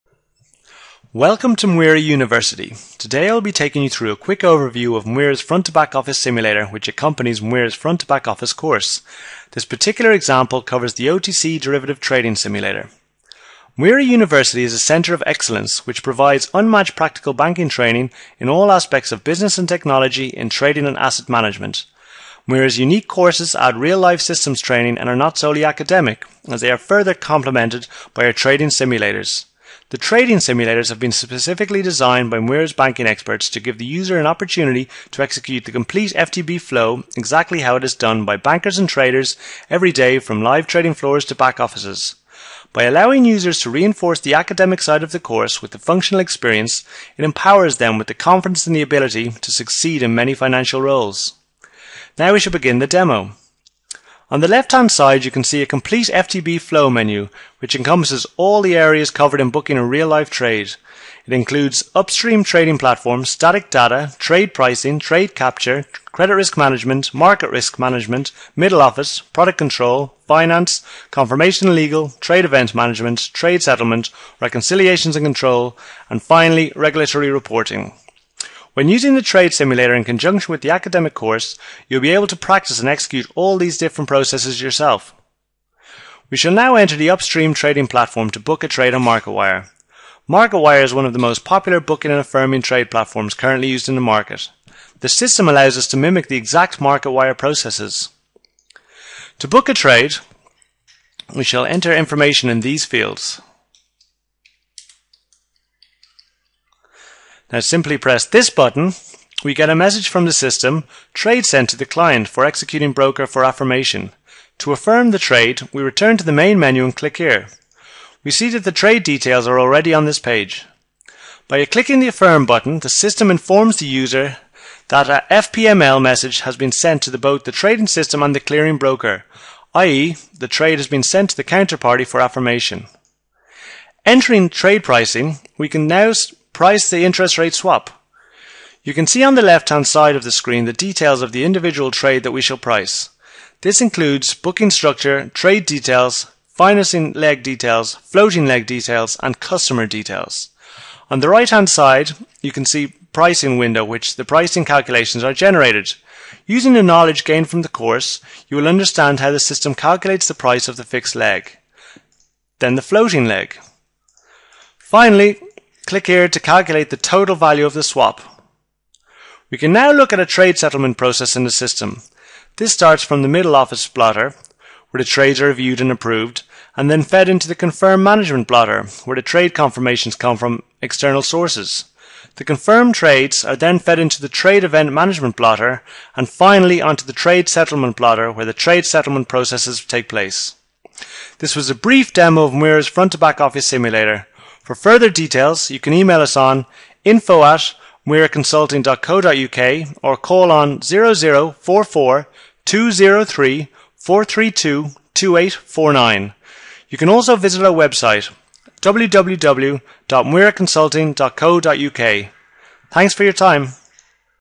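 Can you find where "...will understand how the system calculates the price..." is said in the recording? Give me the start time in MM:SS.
02:38.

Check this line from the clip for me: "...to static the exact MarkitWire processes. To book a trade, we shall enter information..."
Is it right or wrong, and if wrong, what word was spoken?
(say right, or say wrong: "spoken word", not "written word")
wrong: "mimic", not "static".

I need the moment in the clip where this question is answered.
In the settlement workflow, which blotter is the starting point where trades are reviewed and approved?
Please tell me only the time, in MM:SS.
02:53.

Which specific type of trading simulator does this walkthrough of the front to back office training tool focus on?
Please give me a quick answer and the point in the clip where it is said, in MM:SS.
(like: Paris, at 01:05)
OTC derivative trading simulator, at 00:11.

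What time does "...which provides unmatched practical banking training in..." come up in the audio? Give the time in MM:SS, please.
00:15.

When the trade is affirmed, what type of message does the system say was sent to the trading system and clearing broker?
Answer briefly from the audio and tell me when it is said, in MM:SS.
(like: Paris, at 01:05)
FPML message, at 02:05.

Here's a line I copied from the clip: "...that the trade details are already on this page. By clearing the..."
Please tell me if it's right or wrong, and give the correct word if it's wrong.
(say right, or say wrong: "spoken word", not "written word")
wrong: "clicking", not "clearing".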